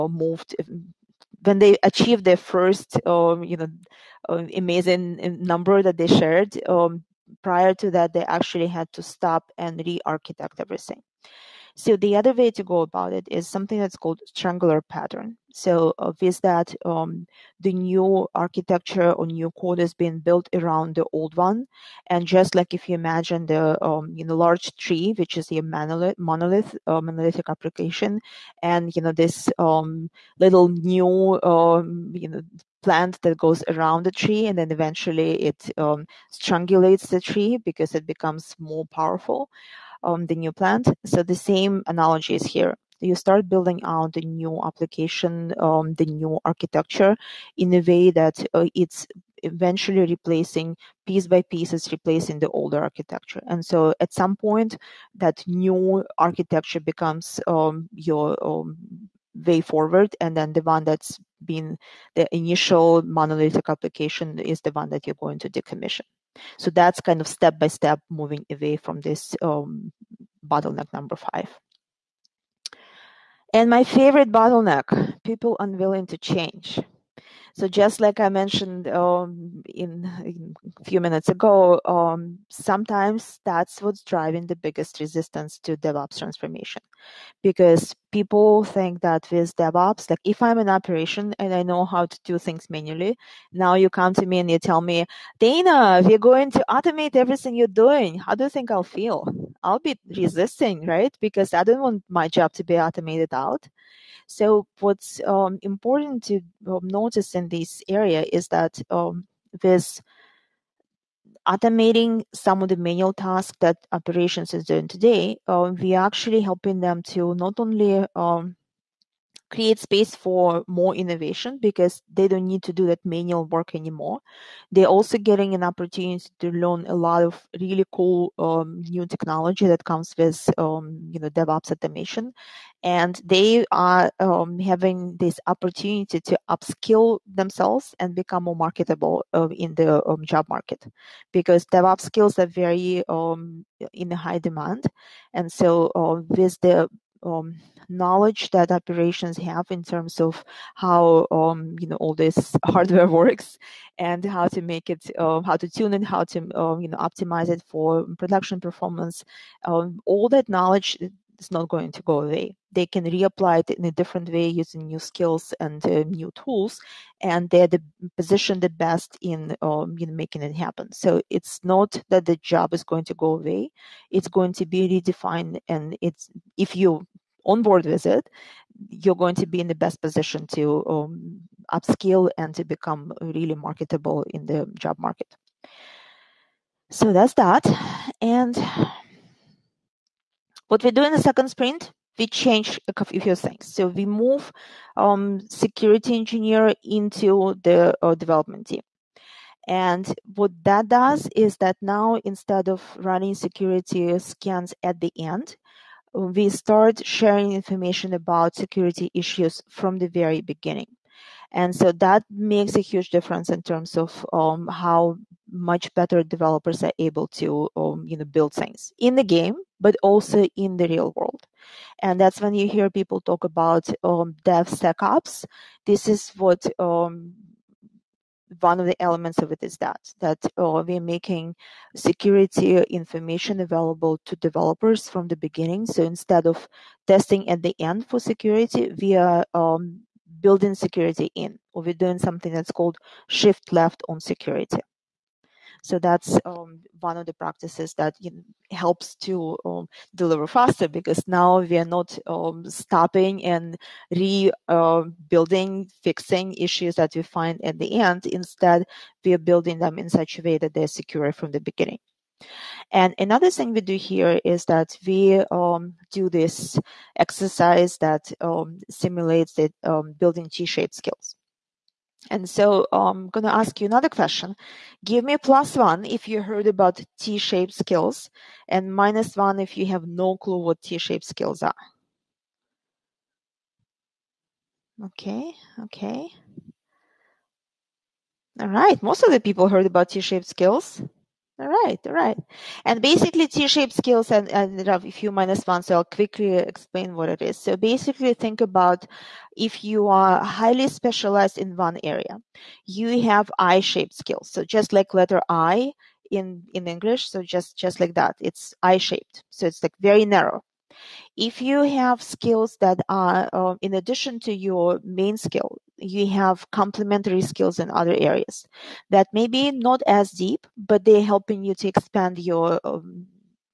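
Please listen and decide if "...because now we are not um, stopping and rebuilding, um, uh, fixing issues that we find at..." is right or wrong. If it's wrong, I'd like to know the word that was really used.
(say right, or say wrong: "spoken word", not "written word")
right.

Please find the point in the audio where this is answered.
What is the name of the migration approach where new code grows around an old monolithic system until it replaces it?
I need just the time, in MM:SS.
00:14.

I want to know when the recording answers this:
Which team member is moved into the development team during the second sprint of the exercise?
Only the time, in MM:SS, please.
03:15.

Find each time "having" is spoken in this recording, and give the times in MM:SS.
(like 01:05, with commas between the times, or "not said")
02:14.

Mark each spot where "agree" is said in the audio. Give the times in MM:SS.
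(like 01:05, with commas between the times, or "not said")
not said.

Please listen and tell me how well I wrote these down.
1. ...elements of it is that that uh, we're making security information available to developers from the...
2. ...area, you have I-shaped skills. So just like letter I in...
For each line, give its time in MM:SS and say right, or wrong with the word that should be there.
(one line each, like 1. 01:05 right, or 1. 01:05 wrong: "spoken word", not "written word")
1. 03:49 right
2. 05:02 right.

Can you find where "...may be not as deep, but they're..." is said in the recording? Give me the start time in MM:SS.
05:19.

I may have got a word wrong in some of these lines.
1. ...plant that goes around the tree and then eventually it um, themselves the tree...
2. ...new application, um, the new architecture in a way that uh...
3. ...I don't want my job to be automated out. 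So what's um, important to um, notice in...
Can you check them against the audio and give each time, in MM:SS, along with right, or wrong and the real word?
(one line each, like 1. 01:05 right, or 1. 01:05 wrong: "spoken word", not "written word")
1. 00:32 wrong: "strangulates", not "themselves"
2. 00:44 right
3. 01:41 right.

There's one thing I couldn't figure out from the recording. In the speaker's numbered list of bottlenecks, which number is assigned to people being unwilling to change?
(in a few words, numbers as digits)
5.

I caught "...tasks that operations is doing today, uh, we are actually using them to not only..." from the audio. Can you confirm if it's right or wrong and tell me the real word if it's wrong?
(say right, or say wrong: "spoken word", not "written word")
wrong: "helping", not "using".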